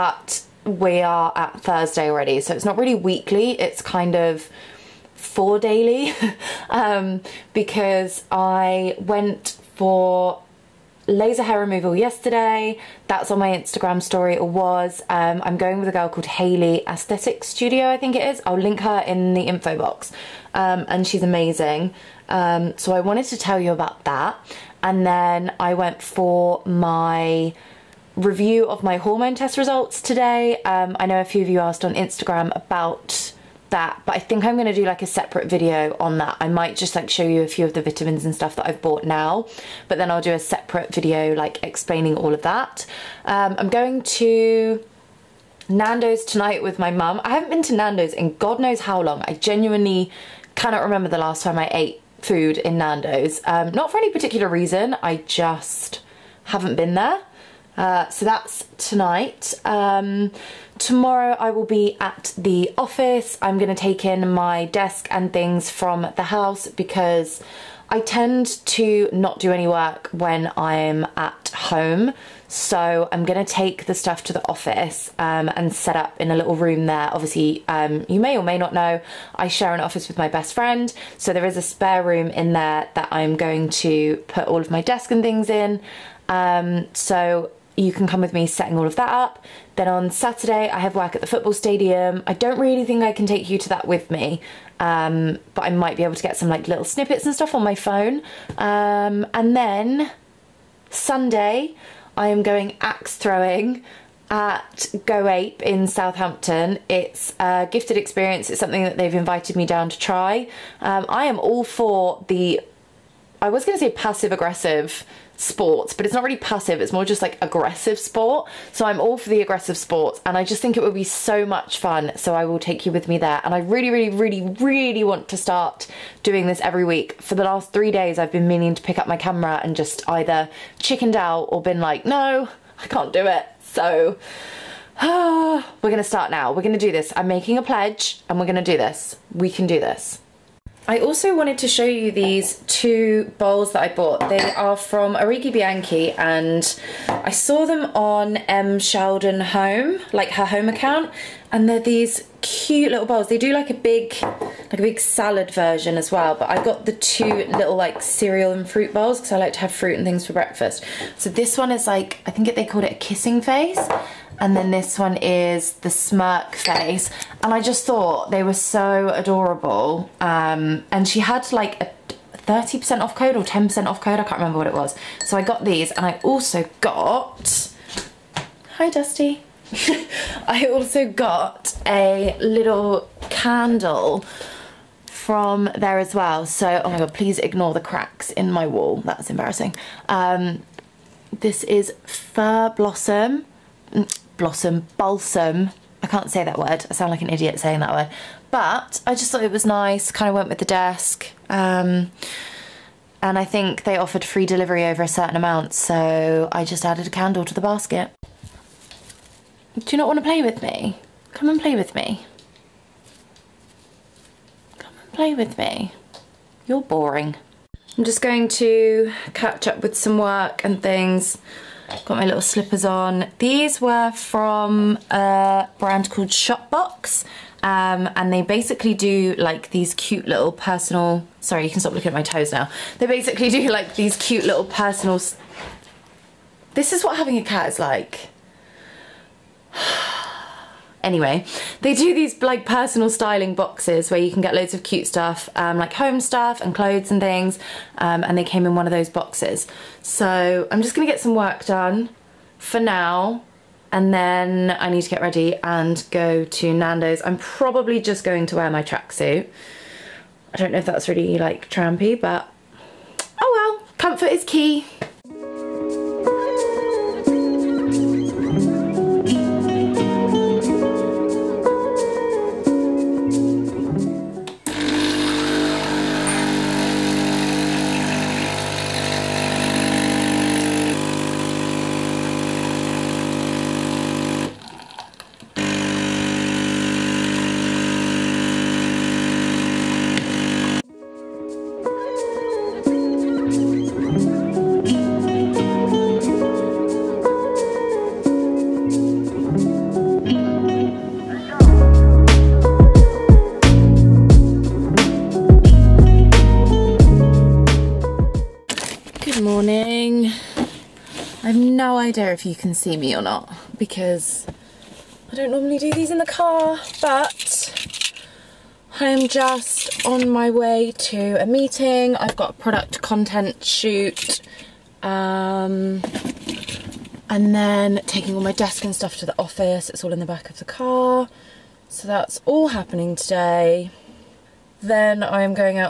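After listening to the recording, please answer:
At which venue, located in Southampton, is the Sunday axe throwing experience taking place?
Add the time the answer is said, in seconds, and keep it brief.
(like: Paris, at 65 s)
Go Ape, at 105 s.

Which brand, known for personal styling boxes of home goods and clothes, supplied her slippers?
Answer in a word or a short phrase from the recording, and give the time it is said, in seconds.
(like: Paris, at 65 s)
Shopbox, at 226 s.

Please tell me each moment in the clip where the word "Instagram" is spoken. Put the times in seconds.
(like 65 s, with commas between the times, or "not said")
13 s, 31 s.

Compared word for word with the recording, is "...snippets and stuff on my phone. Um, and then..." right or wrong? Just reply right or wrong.
right.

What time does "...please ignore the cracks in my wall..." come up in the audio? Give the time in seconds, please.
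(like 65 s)
187 s.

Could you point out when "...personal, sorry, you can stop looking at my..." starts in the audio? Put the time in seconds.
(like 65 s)
230 s.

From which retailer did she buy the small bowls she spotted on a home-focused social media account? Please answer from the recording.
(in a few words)
Arighi Bianchi.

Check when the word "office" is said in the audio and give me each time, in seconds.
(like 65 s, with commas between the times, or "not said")
62 s, 74 s, 79 s, 329 s.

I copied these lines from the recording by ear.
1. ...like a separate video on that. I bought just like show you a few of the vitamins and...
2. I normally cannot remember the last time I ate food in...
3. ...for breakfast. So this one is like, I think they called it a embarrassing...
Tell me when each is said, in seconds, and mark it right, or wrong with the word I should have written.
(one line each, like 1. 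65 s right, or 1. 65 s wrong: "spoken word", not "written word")
1. 34 s wrong: "might", not "bought"
2. 49 s wrong: "genuinely", not "normally"
3. 160 s wrong: "kissing", not "embarrassing".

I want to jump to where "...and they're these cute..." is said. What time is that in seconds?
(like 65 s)
151 s.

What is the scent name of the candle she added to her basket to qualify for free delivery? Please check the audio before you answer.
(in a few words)
Blossom Balsam.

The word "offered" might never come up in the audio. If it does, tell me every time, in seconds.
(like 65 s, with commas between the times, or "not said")
203 s.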